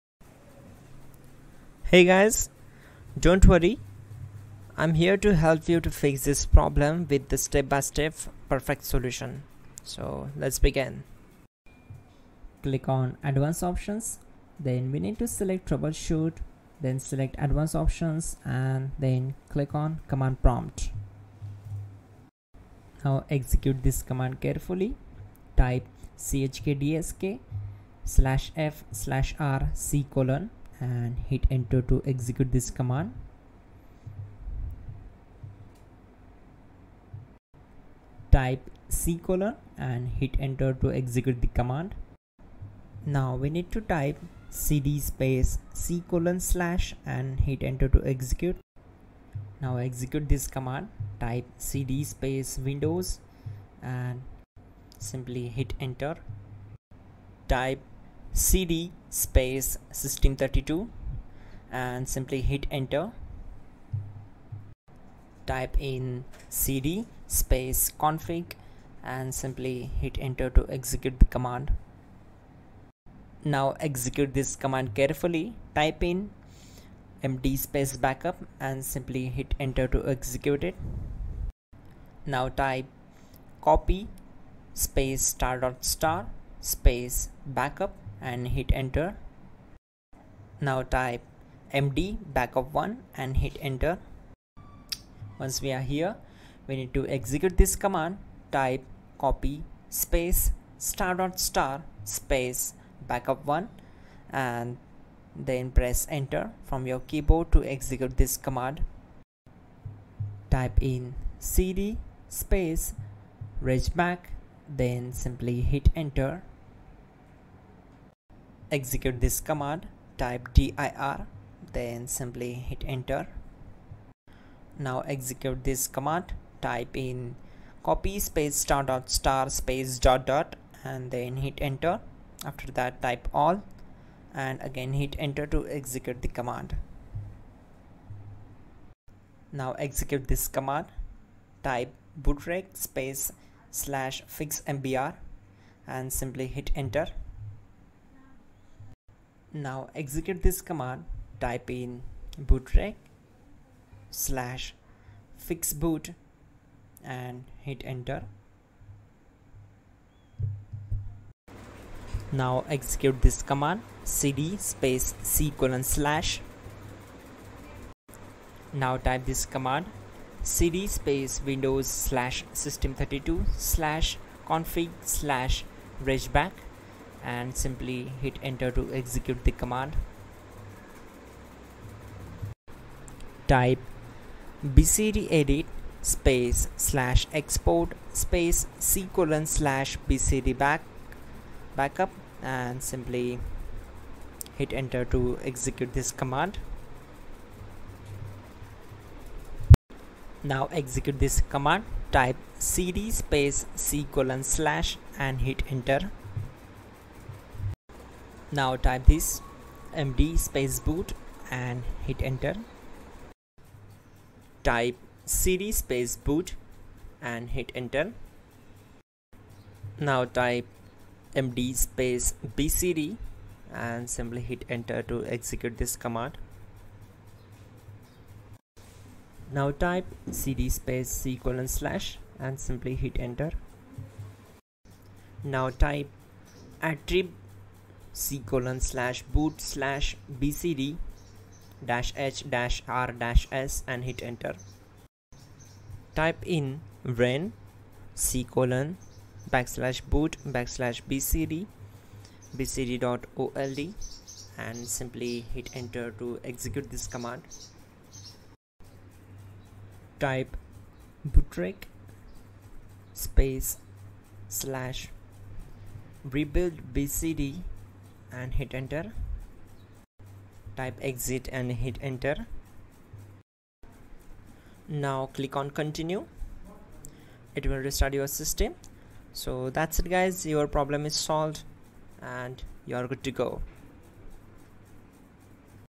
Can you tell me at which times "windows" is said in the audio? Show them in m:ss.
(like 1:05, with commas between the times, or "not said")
0:52, 2:51.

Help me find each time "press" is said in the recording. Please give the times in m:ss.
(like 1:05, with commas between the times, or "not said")
1:45.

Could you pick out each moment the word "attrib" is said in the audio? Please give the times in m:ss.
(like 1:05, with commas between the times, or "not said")
3:56.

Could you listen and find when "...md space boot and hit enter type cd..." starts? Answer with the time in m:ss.
3:29.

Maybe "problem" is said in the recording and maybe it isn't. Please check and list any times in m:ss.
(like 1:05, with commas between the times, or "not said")
0:06, 4:40.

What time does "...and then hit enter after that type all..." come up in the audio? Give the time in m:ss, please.
2:10.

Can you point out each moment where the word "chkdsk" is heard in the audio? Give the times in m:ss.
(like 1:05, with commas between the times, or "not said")
0:26.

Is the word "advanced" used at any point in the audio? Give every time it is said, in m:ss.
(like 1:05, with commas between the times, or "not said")
0:13, 0:17.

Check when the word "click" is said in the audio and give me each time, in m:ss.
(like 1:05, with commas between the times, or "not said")
0:12, 0:19, 4:35.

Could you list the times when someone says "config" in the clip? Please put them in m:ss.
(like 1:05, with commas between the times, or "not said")
1:07, 2:54.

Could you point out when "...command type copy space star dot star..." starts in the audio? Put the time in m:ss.
1:37.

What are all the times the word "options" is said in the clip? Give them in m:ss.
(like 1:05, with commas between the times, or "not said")
0:13, 0:17.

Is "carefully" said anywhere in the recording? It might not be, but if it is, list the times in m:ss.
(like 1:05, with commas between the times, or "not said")
0:24, 1:14.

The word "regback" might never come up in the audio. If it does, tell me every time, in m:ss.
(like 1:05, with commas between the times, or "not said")
1:53, 2:56.